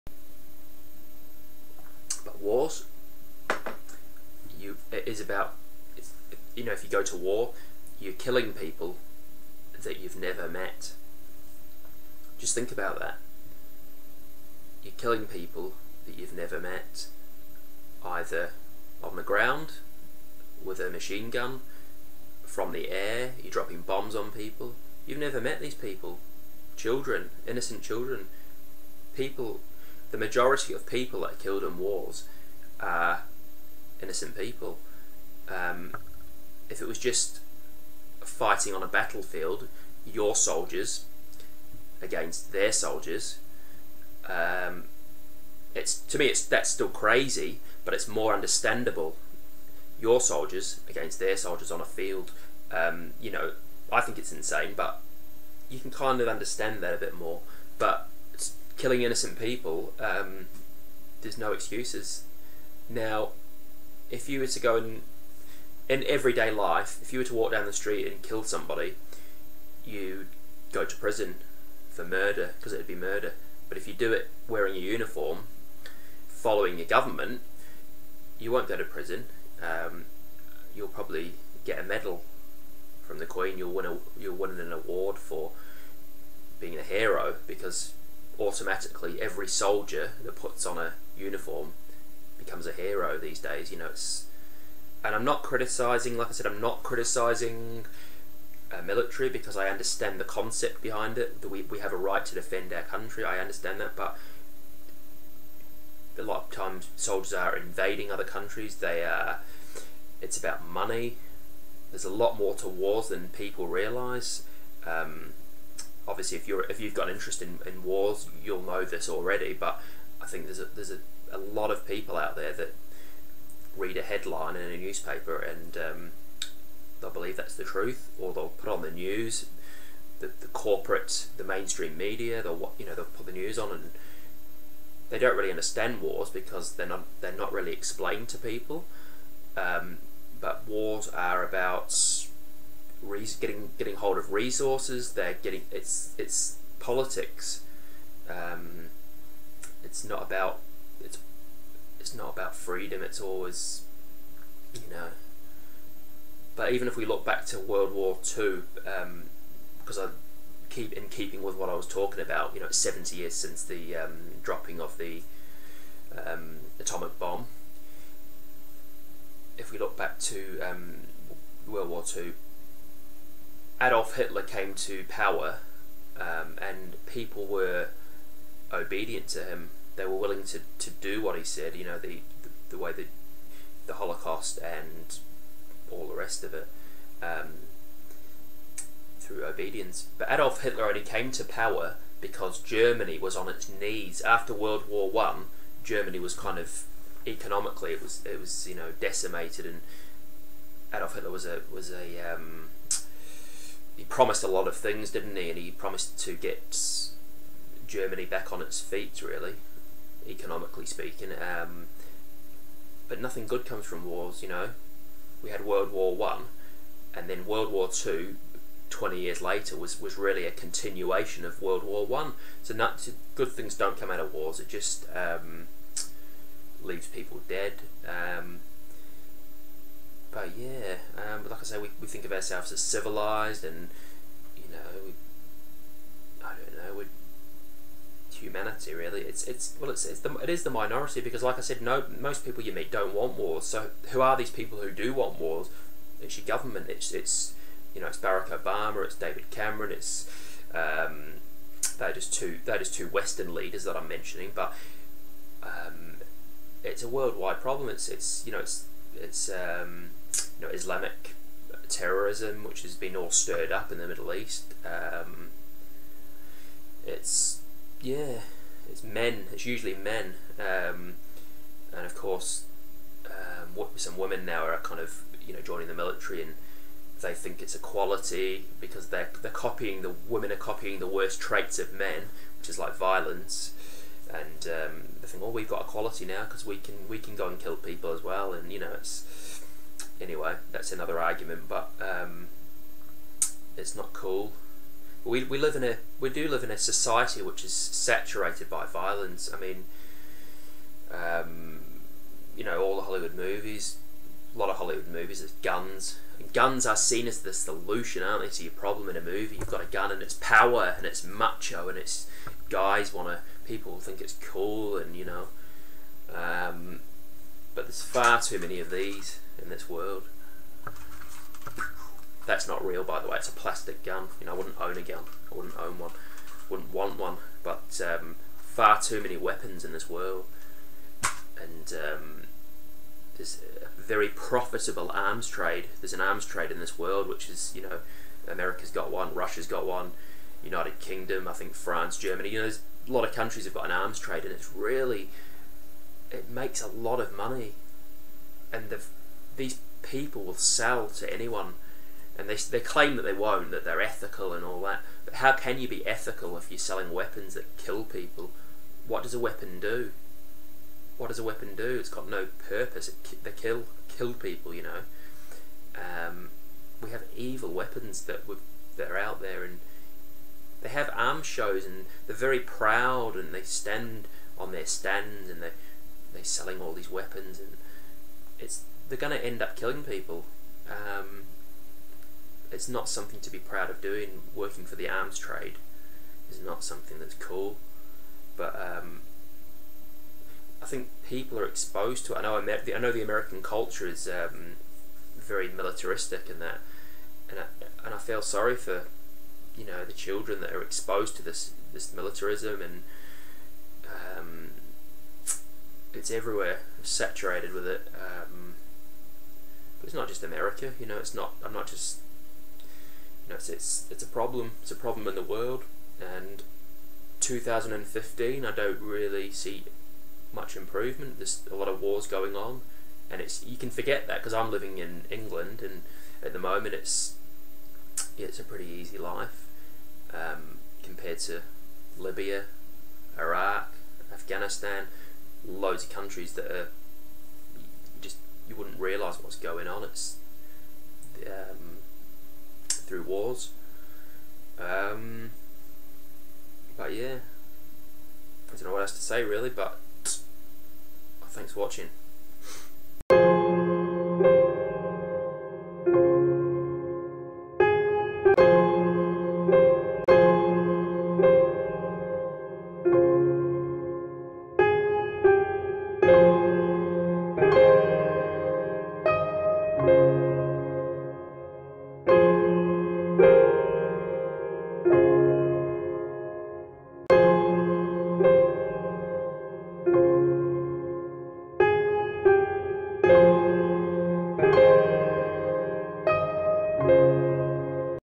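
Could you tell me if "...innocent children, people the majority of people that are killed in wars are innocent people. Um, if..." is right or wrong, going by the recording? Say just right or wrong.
right.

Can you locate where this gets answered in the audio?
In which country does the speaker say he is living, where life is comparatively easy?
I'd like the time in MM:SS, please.
07:05.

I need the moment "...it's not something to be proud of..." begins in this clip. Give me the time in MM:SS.
06:22.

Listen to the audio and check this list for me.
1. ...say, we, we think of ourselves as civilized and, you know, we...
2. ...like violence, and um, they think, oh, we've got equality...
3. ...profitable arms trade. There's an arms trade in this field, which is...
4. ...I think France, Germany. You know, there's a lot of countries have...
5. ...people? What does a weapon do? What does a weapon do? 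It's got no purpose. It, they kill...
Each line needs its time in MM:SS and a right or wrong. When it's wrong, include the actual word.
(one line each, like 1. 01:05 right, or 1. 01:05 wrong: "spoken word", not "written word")
1. 03:51 right
2. 04:42 right
3. 05:34 wrong: "world", not "field"
4. 05:41 right
5. 05:58 right.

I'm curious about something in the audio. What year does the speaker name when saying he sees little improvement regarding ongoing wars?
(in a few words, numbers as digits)
2015.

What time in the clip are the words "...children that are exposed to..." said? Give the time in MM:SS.
06:40.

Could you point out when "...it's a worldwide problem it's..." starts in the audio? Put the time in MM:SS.
04:16.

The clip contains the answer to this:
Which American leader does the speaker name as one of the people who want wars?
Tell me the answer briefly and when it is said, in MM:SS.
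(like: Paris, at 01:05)
Barack Obama, at 04:08.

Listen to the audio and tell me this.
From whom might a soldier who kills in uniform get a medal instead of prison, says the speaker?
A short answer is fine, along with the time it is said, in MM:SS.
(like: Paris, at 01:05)
The Queen, at 01:23.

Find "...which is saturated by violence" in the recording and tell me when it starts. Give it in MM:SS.
04:57.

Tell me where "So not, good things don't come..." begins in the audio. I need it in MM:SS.
03:42.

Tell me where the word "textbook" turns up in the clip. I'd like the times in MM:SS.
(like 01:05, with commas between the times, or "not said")
not said.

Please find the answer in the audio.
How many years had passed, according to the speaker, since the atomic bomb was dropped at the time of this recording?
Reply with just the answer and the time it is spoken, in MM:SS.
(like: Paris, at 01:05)
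70, at 02:42.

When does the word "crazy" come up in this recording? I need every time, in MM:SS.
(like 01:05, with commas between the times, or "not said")
00:46.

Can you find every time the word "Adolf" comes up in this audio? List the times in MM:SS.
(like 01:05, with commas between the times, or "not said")
02:53, 03:10, 03:20.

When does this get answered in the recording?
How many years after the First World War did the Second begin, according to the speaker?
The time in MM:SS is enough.
03:38.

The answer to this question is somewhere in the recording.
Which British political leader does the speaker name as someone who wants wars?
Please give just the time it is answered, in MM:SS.
04:09.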